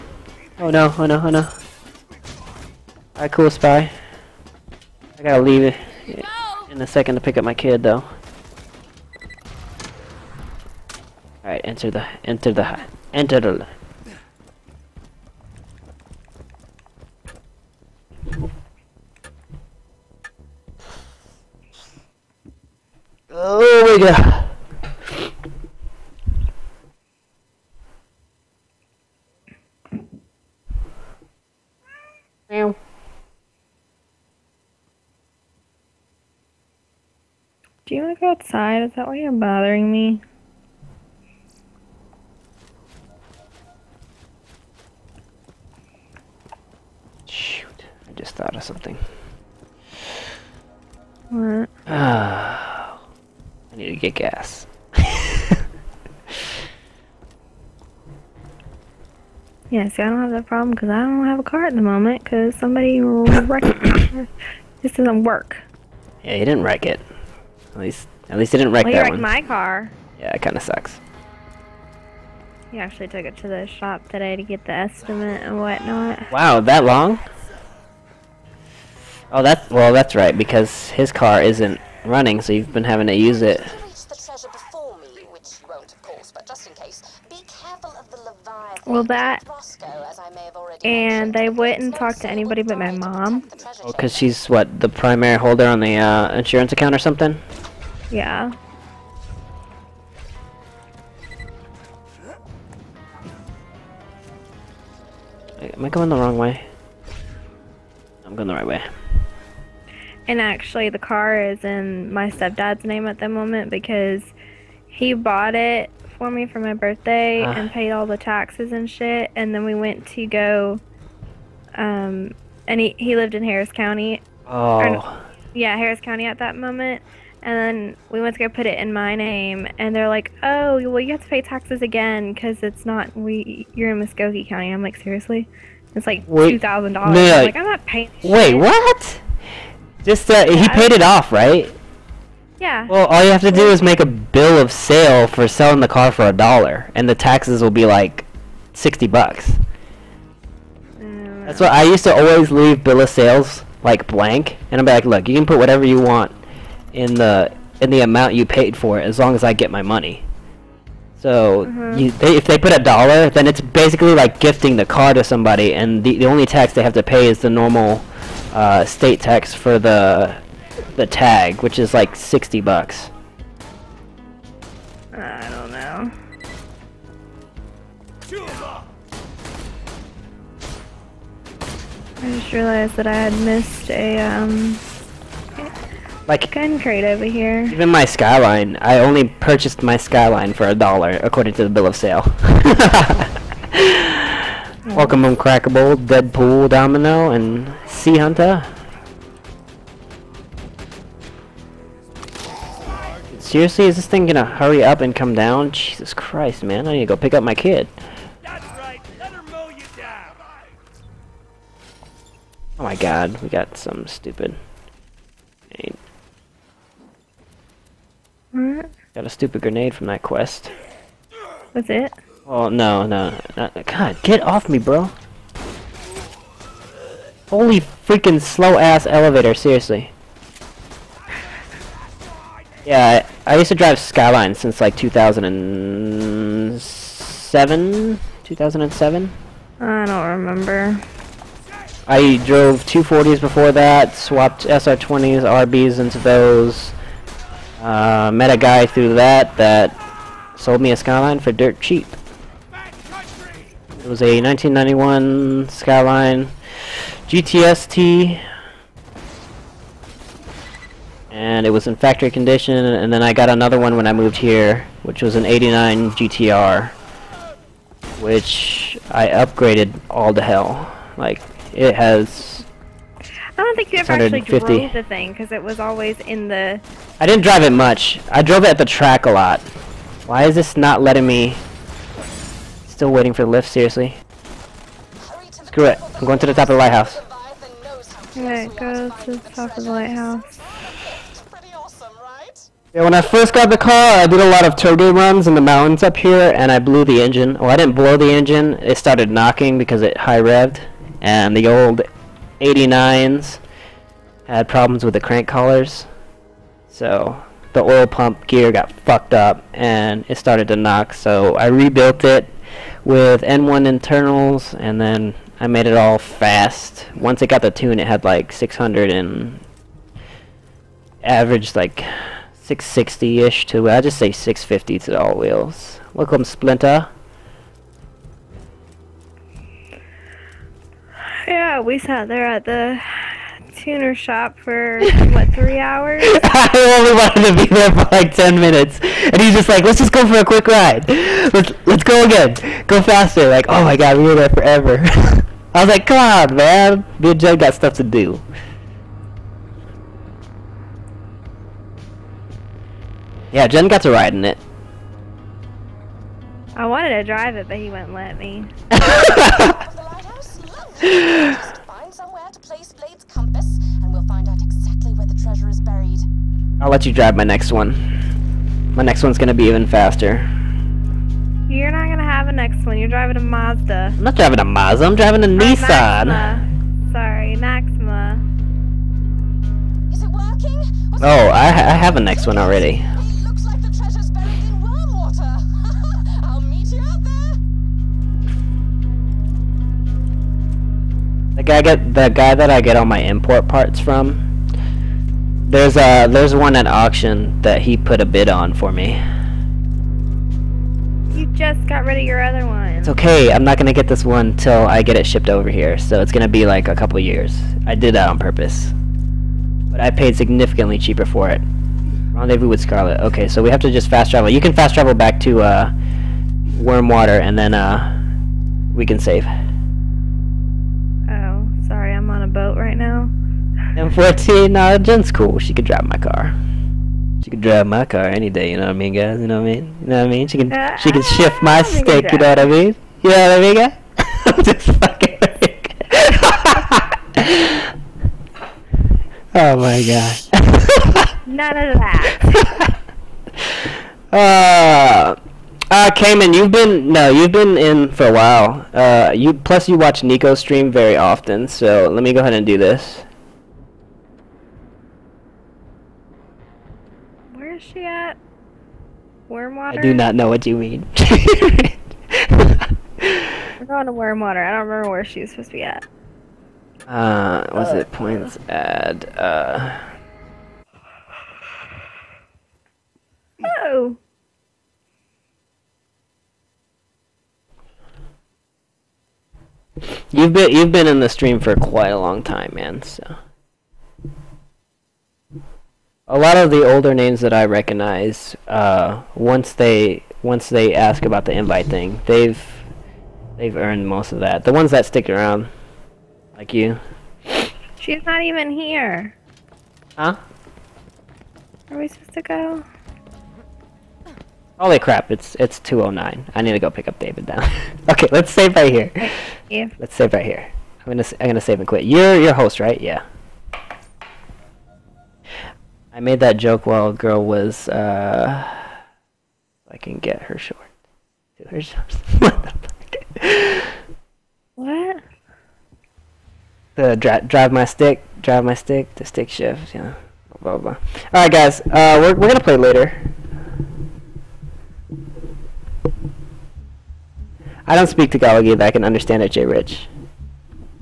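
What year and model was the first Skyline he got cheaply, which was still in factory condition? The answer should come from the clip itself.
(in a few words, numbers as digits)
1991 Skyline GTST.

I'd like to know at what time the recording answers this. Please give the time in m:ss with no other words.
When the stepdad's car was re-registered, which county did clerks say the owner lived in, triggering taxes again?
2:14.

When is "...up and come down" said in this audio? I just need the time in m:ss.
3:24.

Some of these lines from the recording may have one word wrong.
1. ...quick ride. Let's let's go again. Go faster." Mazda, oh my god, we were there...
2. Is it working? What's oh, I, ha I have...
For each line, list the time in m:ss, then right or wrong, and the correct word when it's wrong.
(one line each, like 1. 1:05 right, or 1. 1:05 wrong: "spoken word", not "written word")
1. 5:40 wrong: "Like", not "Mazda"
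2. 6:20 right.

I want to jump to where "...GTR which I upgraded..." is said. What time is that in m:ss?
4:26.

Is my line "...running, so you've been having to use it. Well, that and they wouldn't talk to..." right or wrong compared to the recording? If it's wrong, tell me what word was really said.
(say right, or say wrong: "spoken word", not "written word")
right.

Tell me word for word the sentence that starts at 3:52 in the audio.
Yeah, I, I, used to drive Skyline since like 2007?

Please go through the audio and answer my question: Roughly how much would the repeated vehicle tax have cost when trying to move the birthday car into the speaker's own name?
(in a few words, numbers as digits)
2000 dollars.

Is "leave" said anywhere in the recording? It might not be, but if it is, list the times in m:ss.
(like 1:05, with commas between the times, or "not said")
0:05, 2:32.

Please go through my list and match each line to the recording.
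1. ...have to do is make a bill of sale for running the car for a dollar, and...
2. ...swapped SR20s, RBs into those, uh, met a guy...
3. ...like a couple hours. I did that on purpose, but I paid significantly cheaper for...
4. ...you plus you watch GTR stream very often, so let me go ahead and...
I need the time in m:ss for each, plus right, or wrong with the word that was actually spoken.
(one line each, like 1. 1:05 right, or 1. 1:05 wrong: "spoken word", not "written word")
1. 2:23 wrong: "selling", not "running"
2. 4:04 right
3. 6:46 wrong: "years", not "hours"
4. 7:29 wrong: "Nico", not "GTR".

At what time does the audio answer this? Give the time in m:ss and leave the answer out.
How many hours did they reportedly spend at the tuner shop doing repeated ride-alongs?
5:35.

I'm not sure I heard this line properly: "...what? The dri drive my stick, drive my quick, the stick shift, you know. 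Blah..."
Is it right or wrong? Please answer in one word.
wrong.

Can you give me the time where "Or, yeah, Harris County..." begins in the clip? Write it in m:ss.
2:04.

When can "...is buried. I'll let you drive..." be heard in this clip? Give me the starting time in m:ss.
6:05.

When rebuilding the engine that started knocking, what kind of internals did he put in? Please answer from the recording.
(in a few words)
N1.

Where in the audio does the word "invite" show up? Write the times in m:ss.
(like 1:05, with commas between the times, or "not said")
8:11.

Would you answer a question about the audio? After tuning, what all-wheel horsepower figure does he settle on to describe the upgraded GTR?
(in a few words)
650.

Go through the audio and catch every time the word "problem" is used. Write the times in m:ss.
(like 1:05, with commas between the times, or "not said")
1:00, 5:04.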